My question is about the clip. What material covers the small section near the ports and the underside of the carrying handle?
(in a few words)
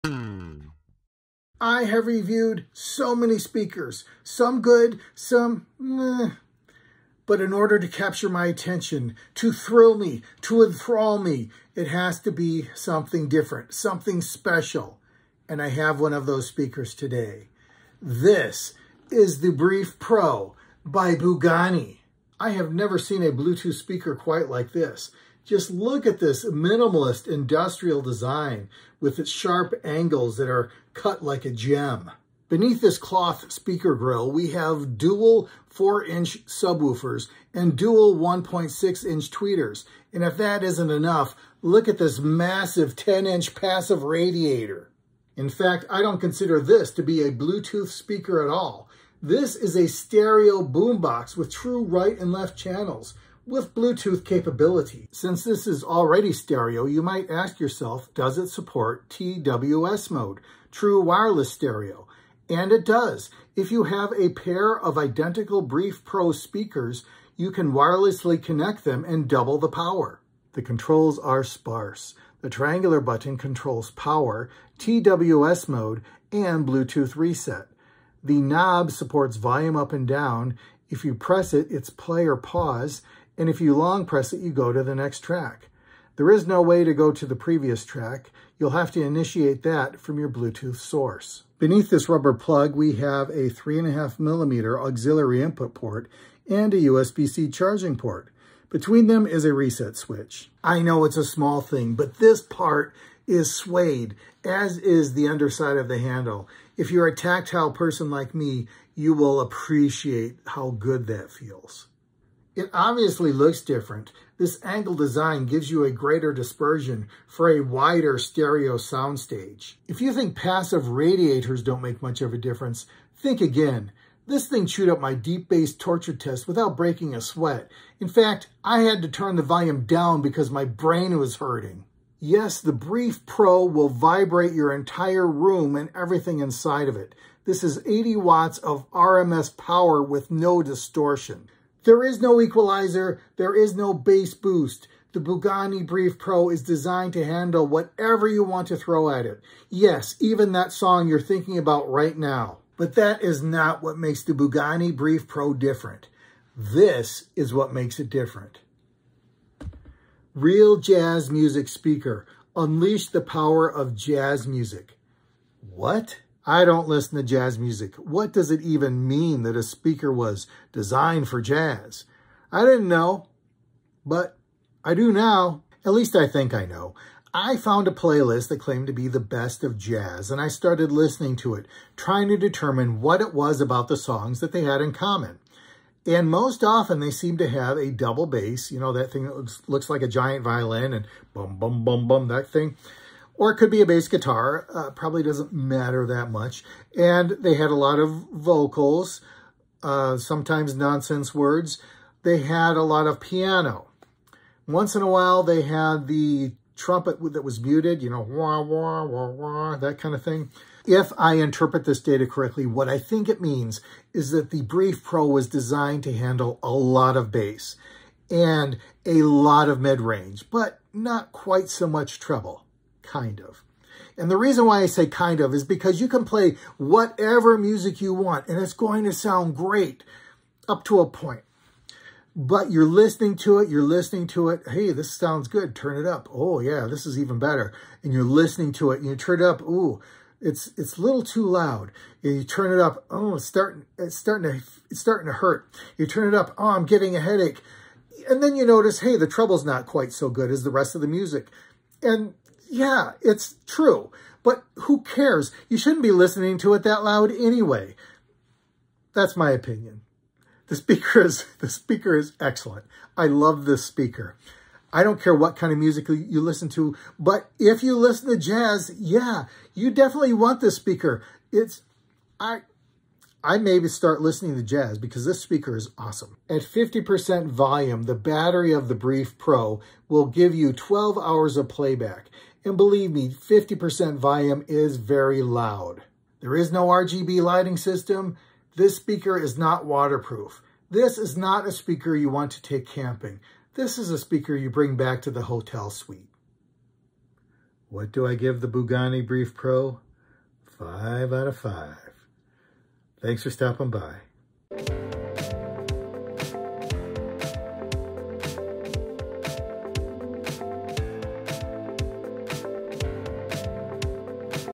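suede.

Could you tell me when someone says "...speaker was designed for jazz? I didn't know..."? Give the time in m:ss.
2:49.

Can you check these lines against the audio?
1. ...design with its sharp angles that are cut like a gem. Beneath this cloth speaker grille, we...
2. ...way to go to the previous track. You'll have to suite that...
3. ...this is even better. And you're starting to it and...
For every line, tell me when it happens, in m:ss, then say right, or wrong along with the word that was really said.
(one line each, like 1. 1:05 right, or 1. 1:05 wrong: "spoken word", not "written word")
1. 0:28 right
2. 1:26 wrong: "initiate", not "suite"
3. 3:56 wrong: "listening", not "starting".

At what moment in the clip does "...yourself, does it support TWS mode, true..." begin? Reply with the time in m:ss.
0:57.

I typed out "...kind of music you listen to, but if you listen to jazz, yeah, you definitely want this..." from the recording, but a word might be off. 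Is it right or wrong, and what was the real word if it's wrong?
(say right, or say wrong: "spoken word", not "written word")
right.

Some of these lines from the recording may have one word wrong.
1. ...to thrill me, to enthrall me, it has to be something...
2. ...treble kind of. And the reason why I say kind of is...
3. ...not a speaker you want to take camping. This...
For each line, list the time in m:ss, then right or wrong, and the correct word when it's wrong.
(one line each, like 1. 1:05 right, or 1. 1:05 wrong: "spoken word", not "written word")
1. 0:09 right
2. 3:42 right
3. 4:51 right.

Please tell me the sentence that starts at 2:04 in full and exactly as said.
This thing chewed up my deep bass torture test without breaking a sweat.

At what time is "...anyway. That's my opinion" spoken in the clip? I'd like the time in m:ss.
4:17.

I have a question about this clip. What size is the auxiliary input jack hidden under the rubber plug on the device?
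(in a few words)
3.5 millimeter.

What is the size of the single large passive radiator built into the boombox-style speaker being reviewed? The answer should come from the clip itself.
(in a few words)
10-inch.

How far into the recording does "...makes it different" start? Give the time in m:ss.
2:37.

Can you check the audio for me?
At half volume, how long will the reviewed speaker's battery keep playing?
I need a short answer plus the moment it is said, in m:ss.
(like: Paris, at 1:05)
12 hours, at 4:40.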